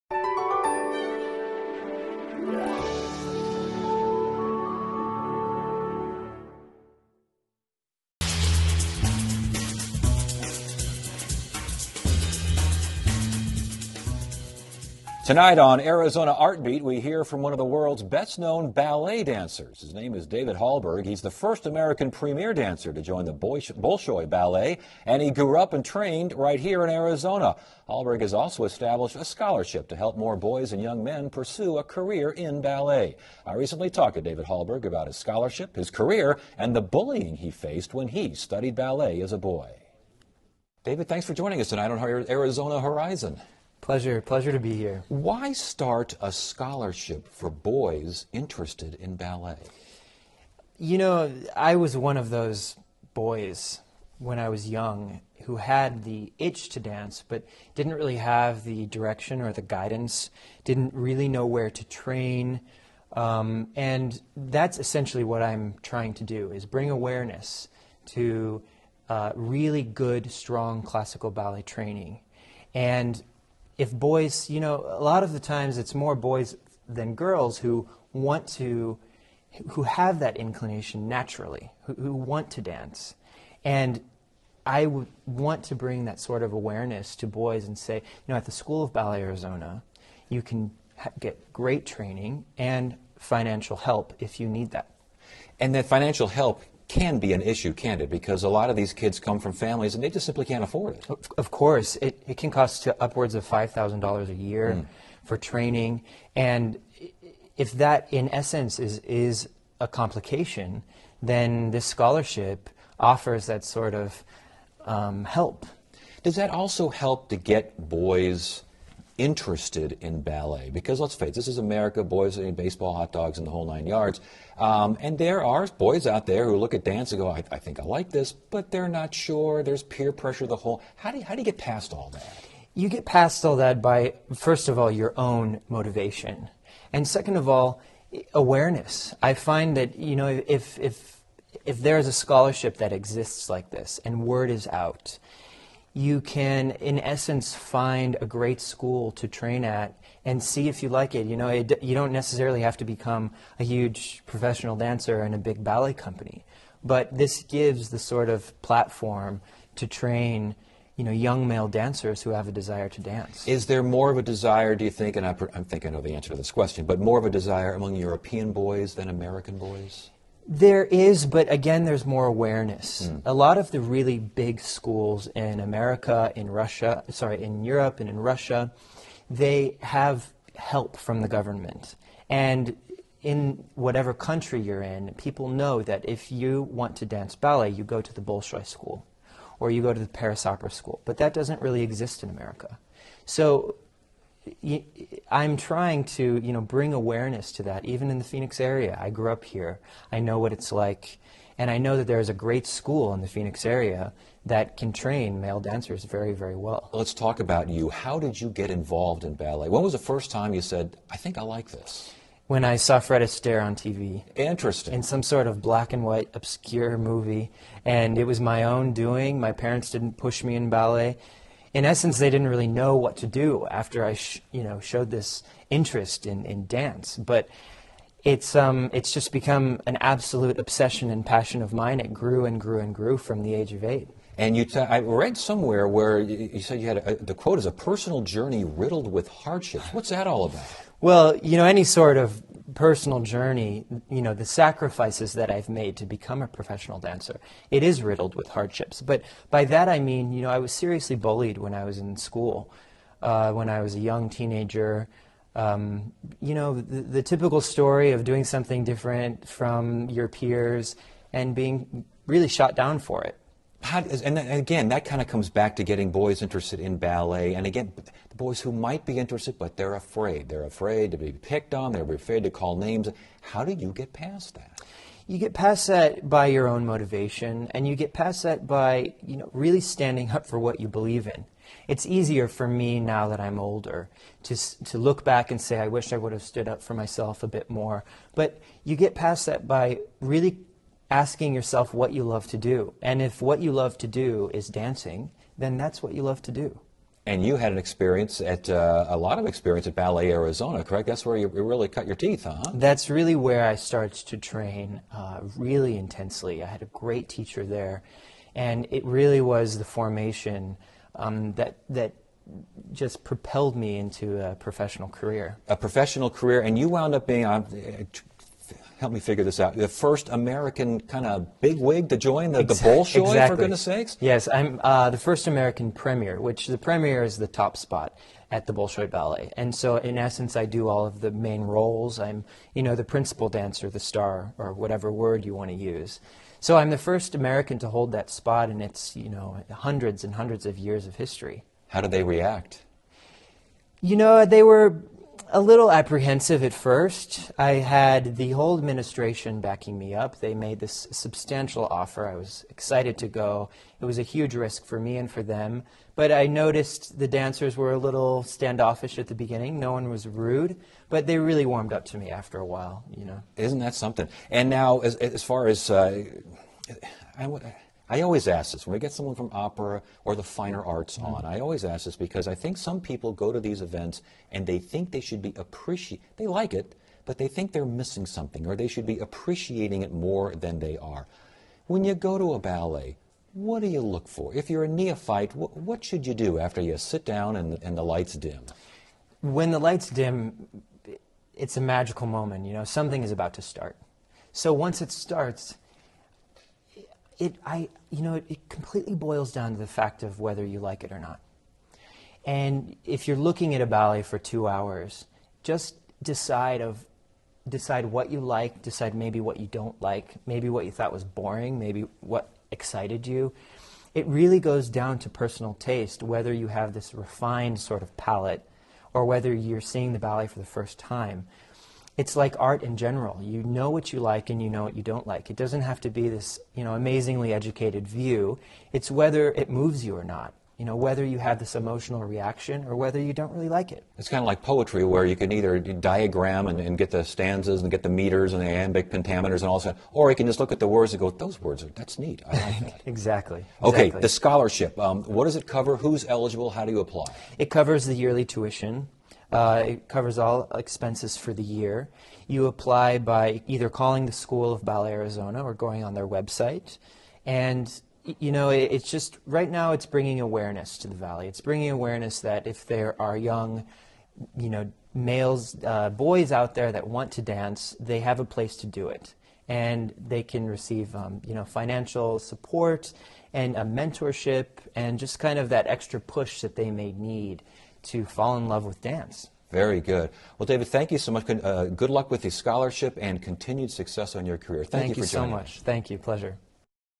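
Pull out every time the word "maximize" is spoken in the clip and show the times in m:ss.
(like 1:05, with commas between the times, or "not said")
not said.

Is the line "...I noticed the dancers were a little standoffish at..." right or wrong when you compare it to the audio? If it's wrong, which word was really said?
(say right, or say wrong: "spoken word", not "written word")
right.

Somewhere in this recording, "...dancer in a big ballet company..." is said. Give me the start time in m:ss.
2:34.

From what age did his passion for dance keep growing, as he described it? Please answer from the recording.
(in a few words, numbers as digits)
8.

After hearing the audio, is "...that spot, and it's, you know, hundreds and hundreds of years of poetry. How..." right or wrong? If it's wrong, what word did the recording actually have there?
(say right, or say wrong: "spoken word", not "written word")
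wrong: "history", not "poetry".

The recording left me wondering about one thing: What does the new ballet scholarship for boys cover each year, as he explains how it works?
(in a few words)
Yearly tuition.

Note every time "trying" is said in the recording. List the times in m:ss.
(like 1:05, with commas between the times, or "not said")
1:05, 3:15.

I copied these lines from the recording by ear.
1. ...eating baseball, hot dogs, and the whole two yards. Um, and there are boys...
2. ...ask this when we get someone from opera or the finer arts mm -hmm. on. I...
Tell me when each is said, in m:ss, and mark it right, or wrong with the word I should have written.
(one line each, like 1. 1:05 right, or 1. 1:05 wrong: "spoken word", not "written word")
1. 2:02 wrong: "nine", not "two"
2. 6:08 right.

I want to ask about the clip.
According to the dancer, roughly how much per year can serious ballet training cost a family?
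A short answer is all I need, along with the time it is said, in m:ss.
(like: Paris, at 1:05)
$5,000, at 1:43.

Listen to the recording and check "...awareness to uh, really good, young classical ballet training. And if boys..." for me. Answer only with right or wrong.
wrong.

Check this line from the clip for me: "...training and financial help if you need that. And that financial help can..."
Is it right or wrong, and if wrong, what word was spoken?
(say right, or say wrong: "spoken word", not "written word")
right.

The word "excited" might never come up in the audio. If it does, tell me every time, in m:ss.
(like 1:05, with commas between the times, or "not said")
5:52, 6:52.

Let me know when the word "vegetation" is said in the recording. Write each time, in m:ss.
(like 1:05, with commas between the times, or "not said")
not said.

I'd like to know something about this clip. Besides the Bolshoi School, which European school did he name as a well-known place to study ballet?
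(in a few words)
Paris Opera School.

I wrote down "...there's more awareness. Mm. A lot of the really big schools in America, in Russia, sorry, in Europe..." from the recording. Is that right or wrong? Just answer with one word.
right.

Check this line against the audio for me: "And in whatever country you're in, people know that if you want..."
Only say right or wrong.
right.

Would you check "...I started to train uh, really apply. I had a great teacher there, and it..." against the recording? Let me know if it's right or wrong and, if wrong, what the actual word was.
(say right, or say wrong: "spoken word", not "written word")
wrong: "intensely", not "apply".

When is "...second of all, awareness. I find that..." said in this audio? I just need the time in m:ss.
2:17.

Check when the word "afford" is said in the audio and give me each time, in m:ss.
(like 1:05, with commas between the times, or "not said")
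1:40.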